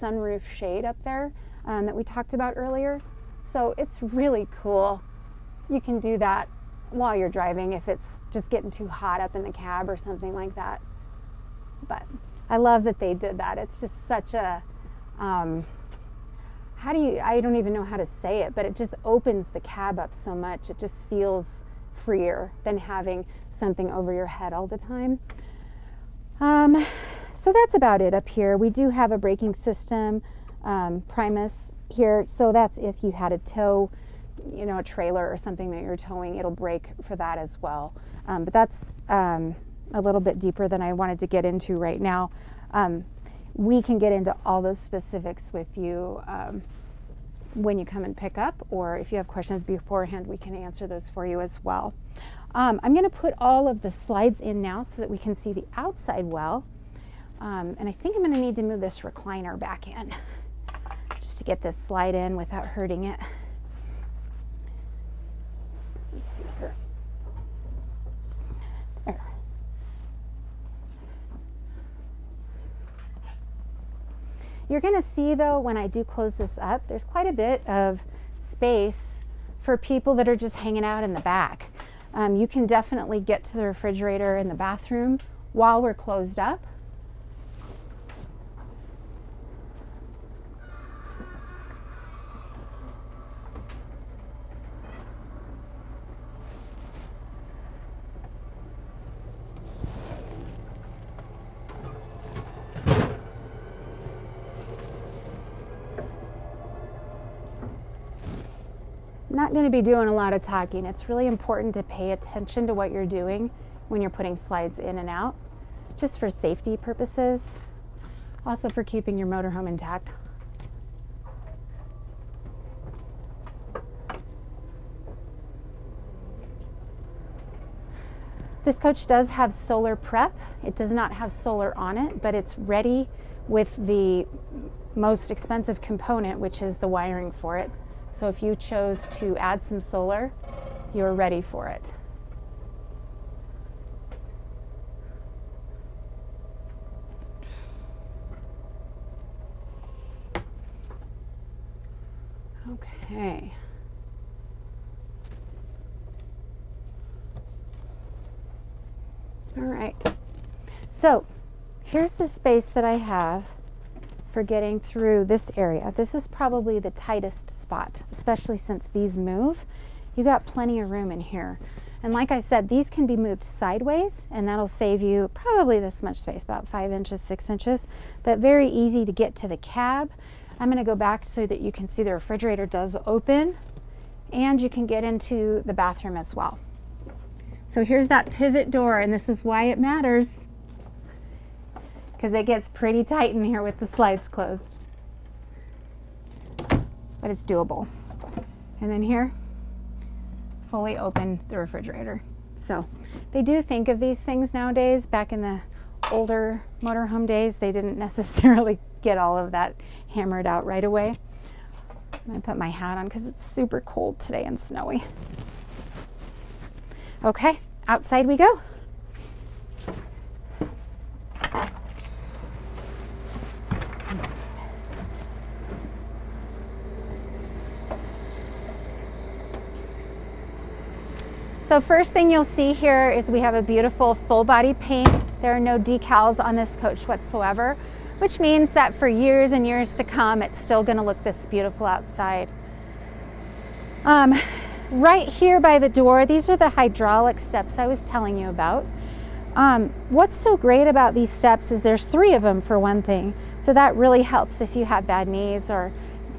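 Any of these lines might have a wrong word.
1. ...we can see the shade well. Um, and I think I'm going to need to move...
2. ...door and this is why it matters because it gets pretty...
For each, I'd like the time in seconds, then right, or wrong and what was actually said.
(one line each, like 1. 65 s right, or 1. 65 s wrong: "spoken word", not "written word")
1. 55 s wrong: "outside", not "shade"
2. 188 s right.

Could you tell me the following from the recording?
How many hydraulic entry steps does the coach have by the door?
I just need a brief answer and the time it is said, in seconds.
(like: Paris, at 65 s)
3, at 252 s.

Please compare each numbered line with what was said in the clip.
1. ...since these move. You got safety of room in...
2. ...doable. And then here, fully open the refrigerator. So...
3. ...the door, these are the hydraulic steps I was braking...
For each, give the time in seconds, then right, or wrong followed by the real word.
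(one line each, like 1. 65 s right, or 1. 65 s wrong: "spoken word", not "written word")
1. 168 s wrong: "plenty", not "safety"
2. 197 s right
3. 245 s wrong: "telling", not "braking".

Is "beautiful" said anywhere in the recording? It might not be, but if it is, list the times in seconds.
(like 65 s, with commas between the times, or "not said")
233 s, 241 s.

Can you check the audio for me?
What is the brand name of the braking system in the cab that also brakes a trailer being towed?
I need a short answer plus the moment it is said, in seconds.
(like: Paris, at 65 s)
Primus, at 31 s.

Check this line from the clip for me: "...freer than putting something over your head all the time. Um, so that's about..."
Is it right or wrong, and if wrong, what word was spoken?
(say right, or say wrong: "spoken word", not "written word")
wrong: "having", not "putting".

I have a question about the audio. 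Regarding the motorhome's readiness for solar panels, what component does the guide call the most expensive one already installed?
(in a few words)
The wiring.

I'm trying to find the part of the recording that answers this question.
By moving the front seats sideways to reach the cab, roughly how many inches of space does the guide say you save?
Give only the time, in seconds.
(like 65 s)
176 s.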